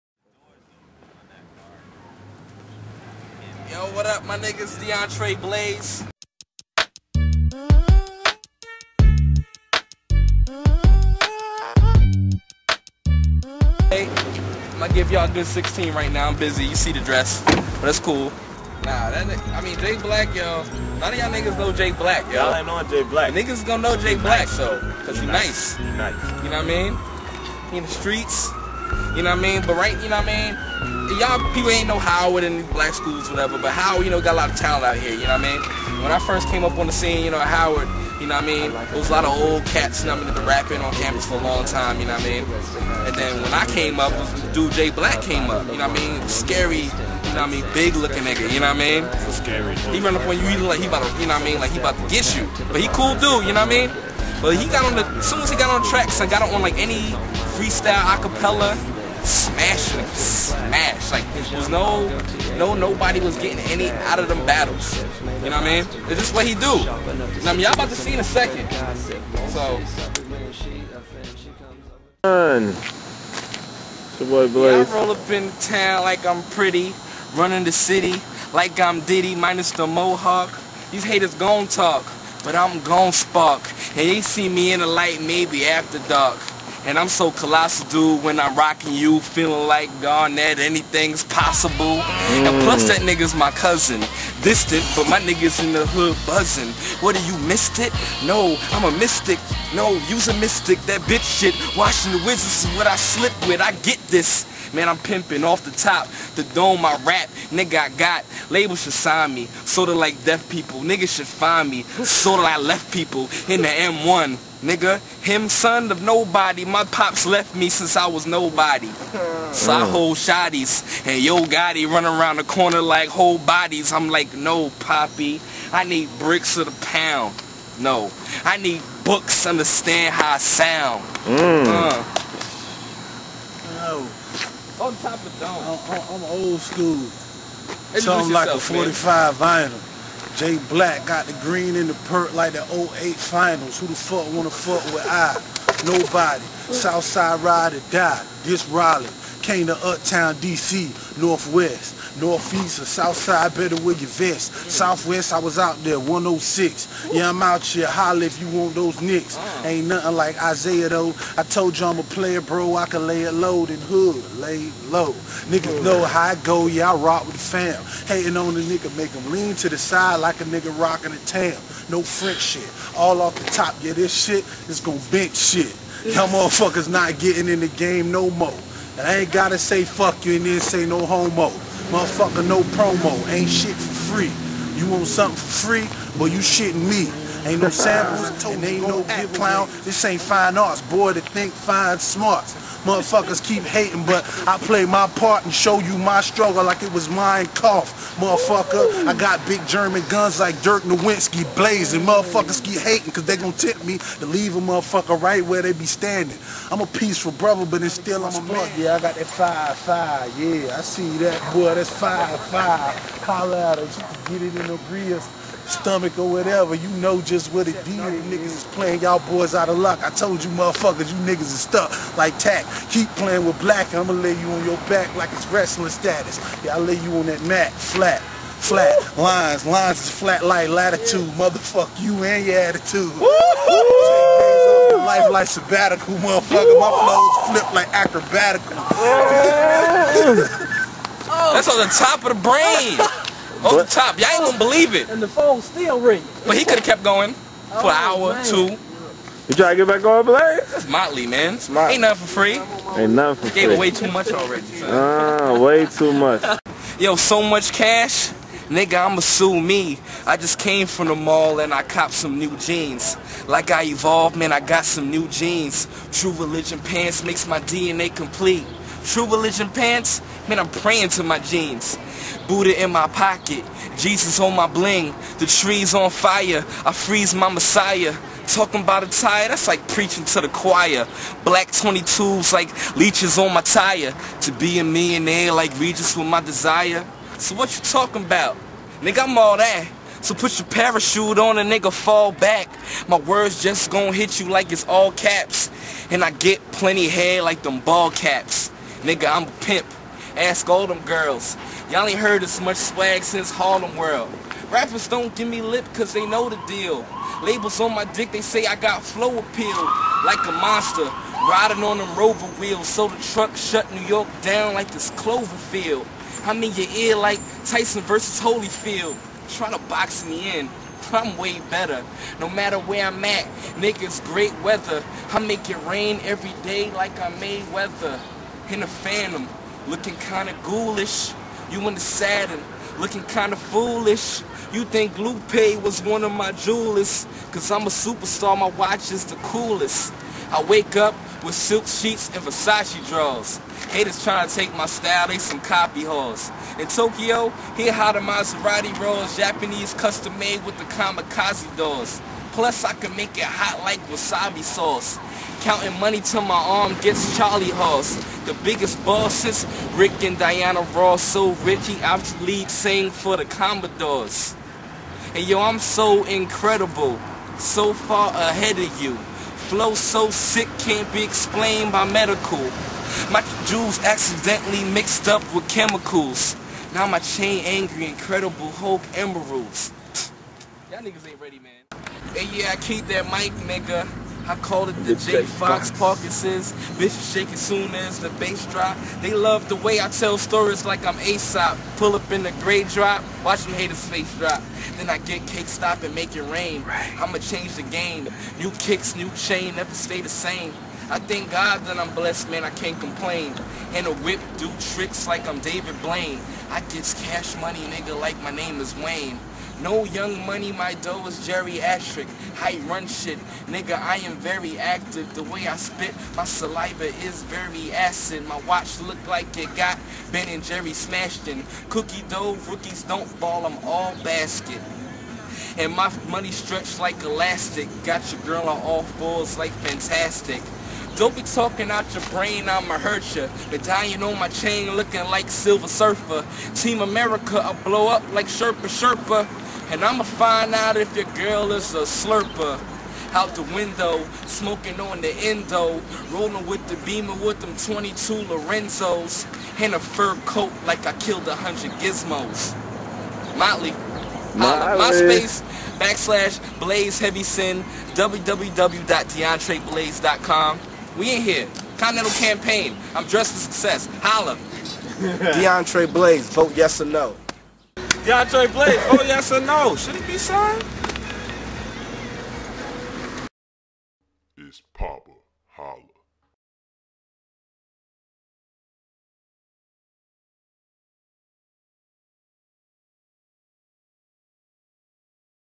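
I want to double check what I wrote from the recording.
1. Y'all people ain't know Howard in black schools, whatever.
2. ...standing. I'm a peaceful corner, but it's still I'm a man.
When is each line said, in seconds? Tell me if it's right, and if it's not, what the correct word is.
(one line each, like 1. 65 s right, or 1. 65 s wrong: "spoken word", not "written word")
1. 31 s right
2. 205 s wrong: "brother", not "corner".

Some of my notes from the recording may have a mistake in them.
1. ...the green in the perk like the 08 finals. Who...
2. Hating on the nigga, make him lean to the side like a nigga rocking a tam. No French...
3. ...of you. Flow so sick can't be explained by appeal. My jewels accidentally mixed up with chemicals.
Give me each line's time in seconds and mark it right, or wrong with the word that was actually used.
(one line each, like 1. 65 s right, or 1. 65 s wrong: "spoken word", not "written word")
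1. 141 s right
2. 168 s right
3. 368 s wrong: "medical", not "appeal".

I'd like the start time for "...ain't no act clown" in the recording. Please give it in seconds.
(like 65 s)
188 s.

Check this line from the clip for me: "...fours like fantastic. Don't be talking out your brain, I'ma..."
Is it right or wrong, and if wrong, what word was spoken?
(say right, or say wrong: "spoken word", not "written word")
right.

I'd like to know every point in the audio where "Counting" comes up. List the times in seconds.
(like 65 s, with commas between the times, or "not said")
355 s.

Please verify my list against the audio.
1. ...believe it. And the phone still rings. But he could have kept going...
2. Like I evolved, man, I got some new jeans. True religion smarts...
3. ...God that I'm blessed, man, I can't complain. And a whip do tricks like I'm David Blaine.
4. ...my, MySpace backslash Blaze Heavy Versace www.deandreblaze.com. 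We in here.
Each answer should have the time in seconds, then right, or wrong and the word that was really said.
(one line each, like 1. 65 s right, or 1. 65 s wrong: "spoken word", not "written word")
1. 244 s right
2. 263 s wrong: "pants", not "smarts"
3. 401 s right
4. 454 s wrong: "Sin", not "Versace".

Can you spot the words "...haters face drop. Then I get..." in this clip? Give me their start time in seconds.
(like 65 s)
393 s.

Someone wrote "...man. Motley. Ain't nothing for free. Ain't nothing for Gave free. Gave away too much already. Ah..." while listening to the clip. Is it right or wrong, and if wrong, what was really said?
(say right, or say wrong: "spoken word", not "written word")
right.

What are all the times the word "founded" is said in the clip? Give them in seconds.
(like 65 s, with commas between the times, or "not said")
not said.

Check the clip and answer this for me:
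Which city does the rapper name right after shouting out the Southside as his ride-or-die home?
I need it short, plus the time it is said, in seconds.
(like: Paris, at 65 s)
Raleigh, at 148 s.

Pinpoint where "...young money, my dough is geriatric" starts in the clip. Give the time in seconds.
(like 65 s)
410 s.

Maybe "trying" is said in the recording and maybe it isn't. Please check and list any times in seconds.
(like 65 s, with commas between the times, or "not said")
319 s, 344 s.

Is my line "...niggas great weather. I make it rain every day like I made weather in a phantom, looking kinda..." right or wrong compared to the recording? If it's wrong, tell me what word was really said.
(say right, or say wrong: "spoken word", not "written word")
right.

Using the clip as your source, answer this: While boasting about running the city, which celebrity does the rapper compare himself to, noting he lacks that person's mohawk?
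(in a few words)
Diddy.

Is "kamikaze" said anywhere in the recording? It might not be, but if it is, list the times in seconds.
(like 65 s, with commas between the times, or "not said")
350 s.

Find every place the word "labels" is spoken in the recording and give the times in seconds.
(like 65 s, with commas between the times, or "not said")
108 s, 307 s.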